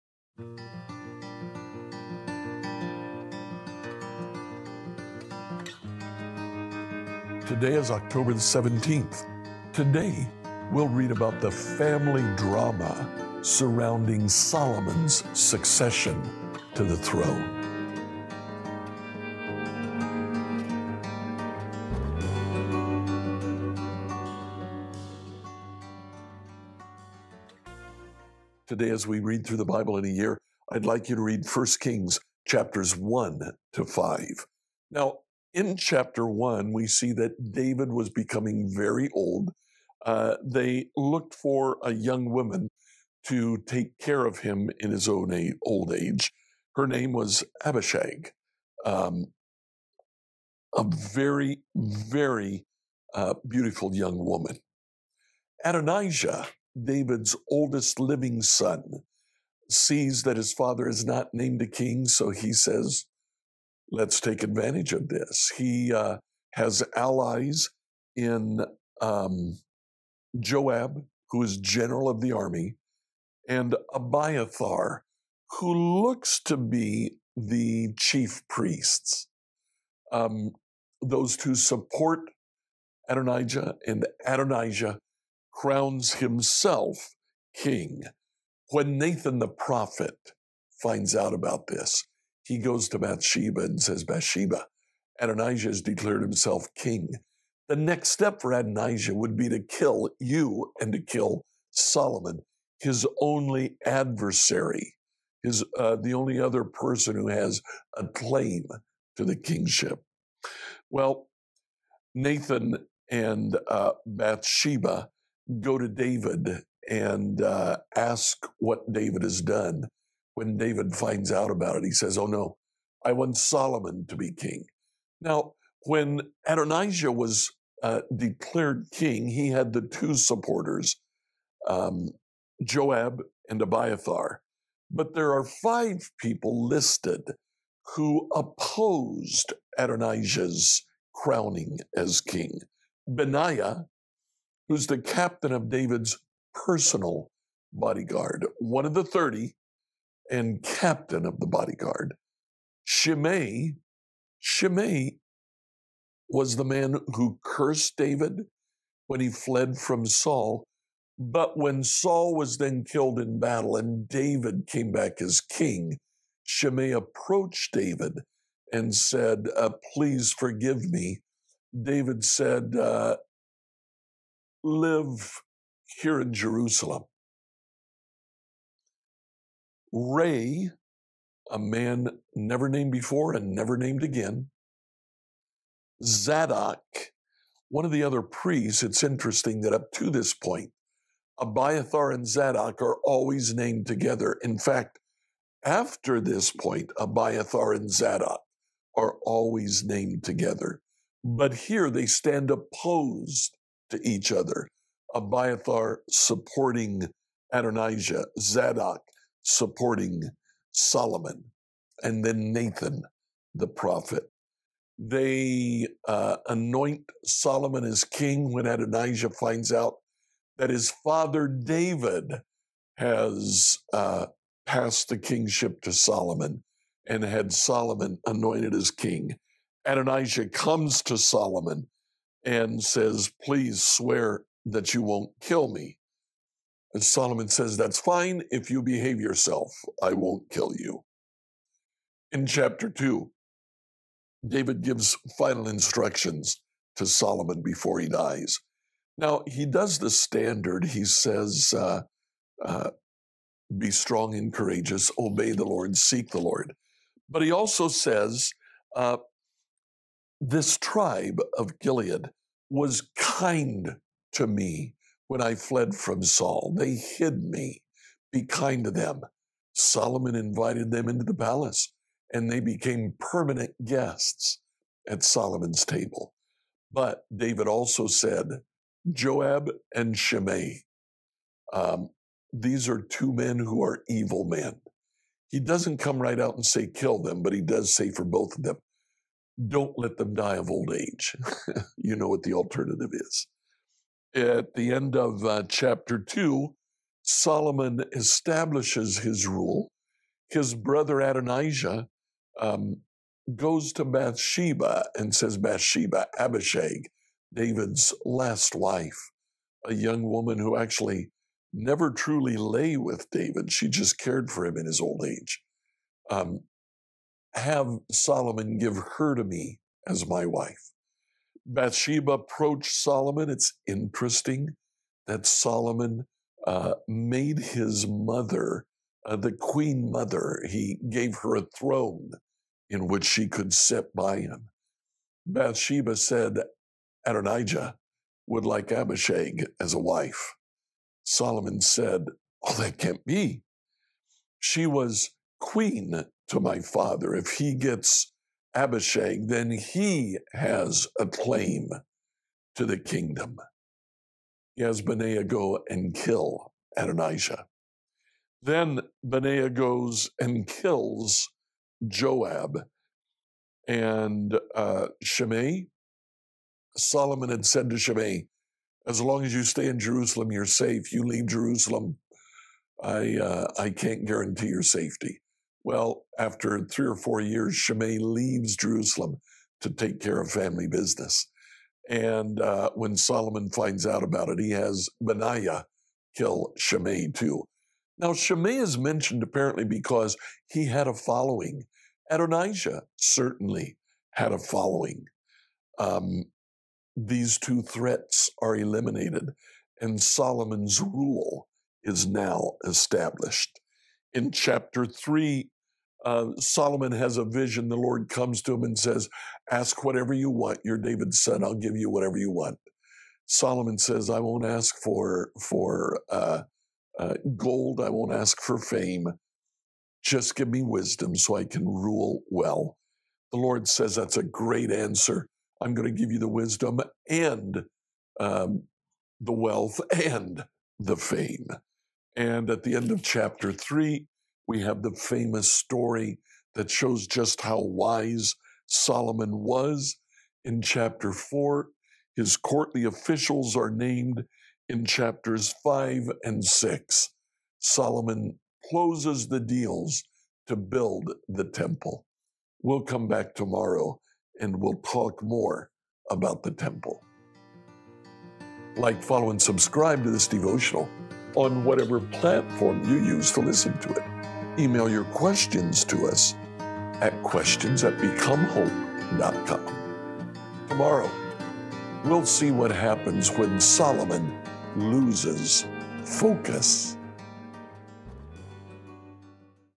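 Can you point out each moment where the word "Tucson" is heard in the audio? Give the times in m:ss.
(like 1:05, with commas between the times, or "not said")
not said.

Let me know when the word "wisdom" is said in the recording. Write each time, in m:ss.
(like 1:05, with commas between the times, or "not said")
7:00, 7:06.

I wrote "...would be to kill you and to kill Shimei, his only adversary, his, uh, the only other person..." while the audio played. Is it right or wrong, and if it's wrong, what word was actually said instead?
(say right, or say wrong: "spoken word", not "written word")
wrong: "Solomon", not "Shimei".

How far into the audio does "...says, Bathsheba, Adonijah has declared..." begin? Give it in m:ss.
1:33.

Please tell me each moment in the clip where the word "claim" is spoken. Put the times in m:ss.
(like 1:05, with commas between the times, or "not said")
1:48, 5:51.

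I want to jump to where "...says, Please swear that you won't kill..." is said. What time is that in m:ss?
3:52.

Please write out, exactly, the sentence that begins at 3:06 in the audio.
Zadok, one of the other priests.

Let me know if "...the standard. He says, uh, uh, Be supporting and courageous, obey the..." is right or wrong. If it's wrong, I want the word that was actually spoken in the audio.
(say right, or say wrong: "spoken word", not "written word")
wrong: "strong", not "supporting".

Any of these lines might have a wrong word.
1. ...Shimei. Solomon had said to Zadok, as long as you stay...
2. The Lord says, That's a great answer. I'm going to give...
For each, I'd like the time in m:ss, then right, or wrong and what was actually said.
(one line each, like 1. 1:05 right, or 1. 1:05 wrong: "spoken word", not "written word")
1. 6:05 wrong: "Shimei", not "Zadok"
2. 7:03 right.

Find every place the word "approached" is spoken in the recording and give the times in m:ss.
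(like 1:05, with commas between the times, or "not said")
2:46, 5:22.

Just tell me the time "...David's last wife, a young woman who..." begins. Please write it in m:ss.
5:07.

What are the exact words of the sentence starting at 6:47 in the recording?
The Lord comes to him and says, Ask whatever you want.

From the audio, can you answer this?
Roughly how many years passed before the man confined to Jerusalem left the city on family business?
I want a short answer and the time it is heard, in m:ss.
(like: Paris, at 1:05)
3 or 4, at 6:16.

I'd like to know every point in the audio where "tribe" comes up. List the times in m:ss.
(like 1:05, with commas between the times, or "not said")
4:20.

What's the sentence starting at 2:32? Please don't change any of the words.
Shimei, Shimei was the man who cursed David when he fled from Saul.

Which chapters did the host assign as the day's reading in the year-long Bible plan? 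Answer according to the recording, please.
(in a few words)
1 Kings 1 to 5.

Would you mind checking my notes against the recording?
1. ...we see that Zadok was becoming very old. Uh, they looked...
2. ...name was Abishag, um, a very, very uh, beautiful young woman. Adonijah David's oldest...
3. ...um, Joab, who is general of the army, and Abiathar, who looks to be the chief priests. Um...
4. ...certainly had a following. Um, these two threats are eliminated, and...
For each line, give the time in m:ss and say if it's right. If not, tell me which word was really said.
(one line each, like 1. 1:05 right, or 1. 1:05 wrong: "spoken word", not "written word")
1. 0:36 wrong: "David", not "Zadok"
2. 0:46 right
3. 1:09 right
4. 6:33 right.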